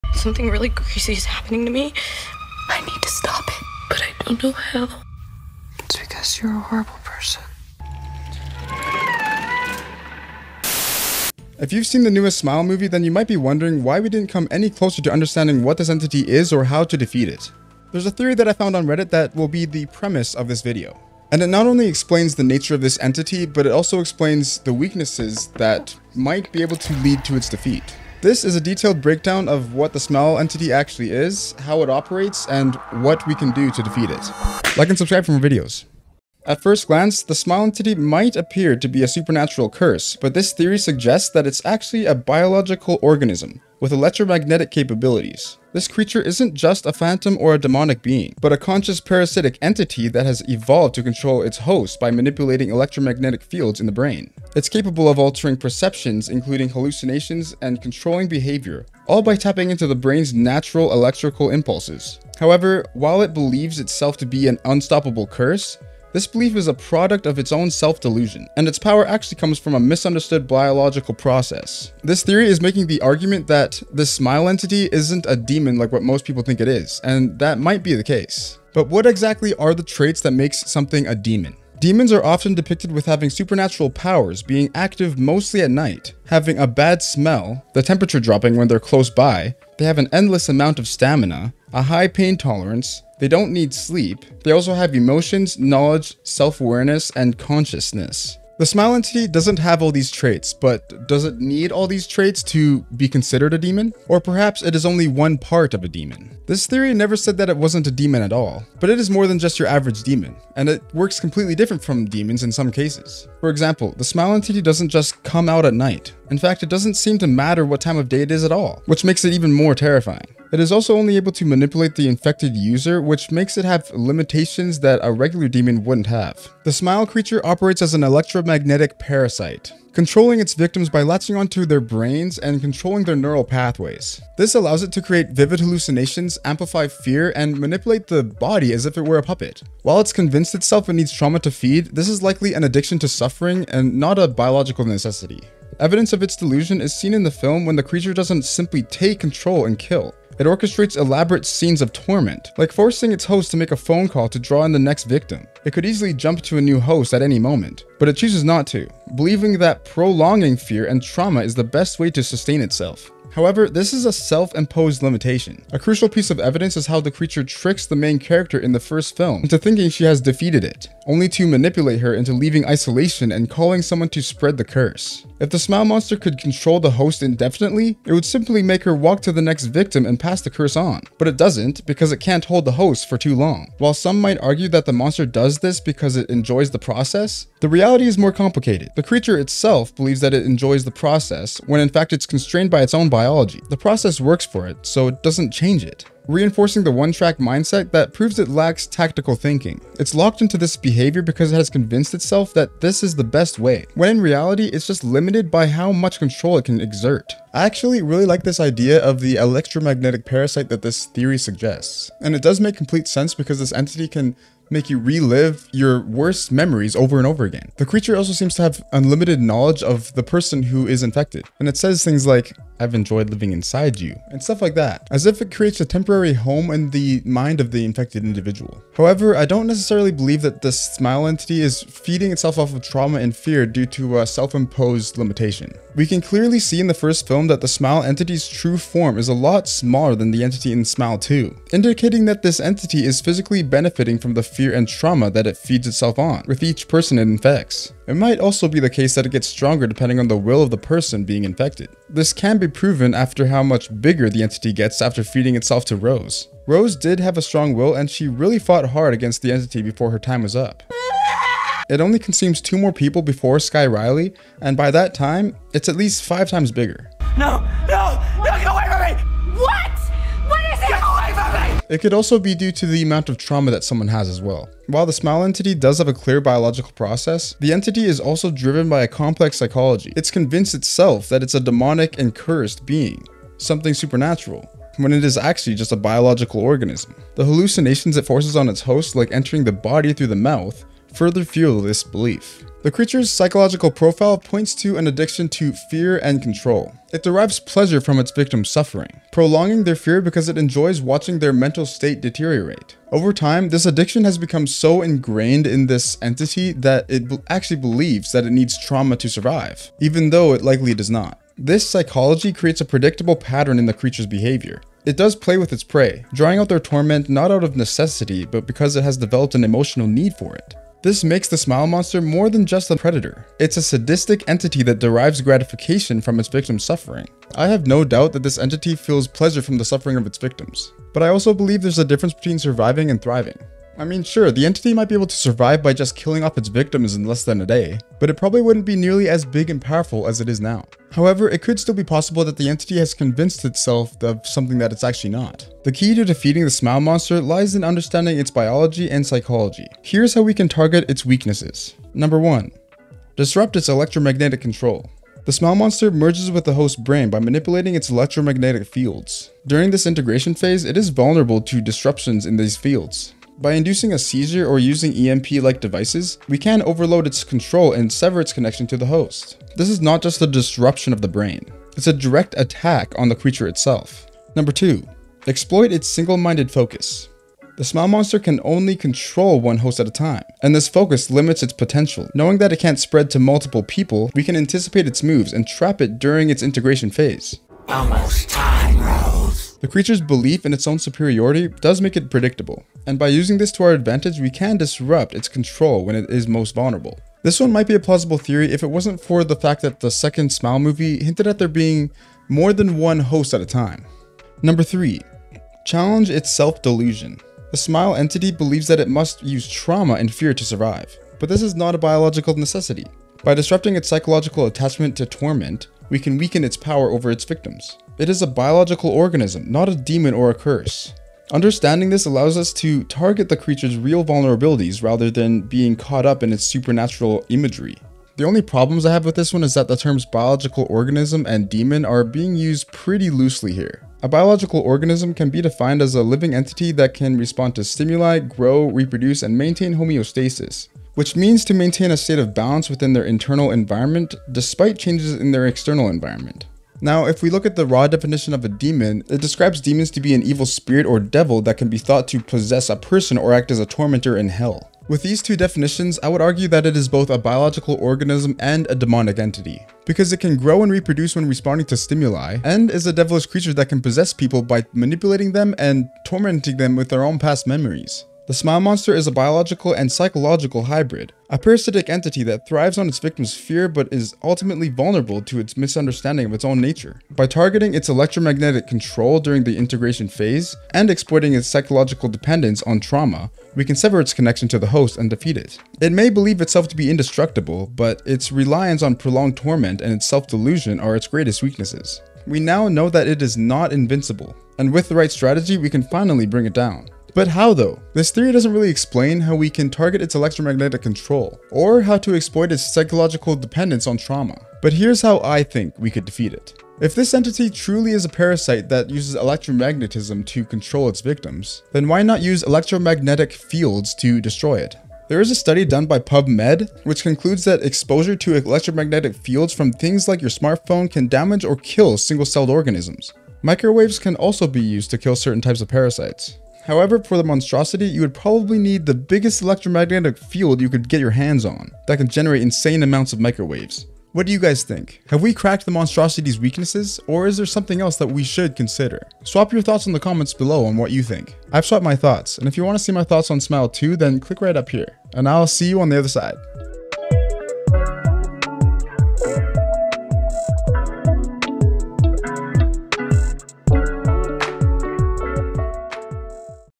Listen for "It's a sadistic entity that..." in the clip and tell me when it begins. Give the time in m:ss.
5:23.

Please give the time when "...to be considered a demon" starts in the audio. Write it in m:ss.
1:42.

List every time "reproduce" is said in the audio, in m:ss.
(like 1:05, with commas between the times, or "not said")
7:18, 7:40.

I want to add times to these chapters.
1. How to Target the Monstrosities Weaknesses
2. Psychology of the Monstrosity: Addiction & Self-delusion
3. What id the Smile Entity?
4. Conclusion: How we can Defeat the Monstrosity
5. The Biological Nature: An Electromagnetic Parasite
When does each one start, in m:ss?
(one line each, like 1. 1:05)
1. 5:45
2. 4:34
3. 0:36
4. 7:48
5. 2:06.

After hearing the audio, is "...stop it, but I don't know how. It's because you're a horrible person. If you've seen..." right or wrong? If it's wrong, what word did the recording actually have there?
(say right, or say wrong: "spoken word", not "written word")
right.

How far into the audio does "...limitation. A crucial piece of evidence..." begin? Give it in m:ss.
2:45.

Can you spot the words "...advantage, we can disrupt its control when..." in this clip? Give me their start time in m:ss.
6:33.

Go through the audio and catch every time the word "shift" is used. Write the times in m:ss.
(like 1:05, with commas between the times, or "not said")
not said.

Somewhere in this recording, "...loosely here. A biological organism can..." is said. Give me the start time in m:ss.
7:13.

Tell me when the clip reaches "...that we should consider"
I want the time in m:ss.
8:58.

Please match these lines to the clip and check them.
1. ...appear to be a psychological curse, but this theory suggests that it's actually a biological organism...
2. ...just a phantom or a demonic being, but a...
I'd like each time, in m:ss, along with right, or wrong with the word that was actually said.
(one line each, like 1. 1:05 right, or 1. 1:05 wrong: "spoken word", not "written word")
1. 0:38 wrong: "supernatural", not "psychological"
2. 0:46 right.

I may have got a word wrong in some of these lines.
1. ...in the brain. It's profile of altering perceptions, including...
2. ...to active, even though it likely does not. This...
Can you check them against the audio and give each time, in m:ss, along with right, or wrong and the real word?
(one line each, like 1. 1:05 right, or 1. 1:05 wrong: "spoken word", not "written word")
1. 0:53 wrong: "capable", not "profile"
2. 5:09 wrong: "survive", not "active".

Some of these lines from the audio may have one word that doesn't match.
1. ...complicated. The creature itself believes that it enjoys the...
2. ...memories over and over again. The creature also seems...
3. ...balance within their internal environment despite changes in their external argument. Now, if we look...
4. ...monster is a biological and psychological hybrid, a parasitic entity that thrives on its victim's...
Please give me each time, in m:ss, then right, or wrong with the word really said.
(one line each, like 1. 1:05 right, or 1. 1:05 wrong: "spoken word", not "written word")
1. 3:08 right
2. 3:36 right
3. 7:22 wrong: "environment", not "argument"
4. 7:48 right.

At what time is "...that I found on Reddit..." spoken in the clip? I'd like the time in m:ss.
0:18.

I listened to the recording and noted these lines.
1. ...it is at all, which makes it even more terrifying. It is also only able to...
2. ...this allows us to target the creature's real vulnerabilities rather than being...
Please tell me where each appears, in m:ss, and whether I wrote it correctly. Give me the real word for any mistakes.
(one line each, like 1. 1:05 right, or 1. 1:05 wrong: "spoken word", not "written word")
1. 1:58 right
2. 7:02 right.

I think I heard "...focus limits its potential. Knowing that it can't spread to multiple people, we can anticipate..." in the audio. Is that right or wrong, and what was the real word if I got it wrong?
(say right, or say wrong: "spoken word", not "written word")
right.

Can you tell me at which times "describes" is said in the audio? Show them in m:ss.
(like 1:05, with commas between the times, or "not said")
7:29.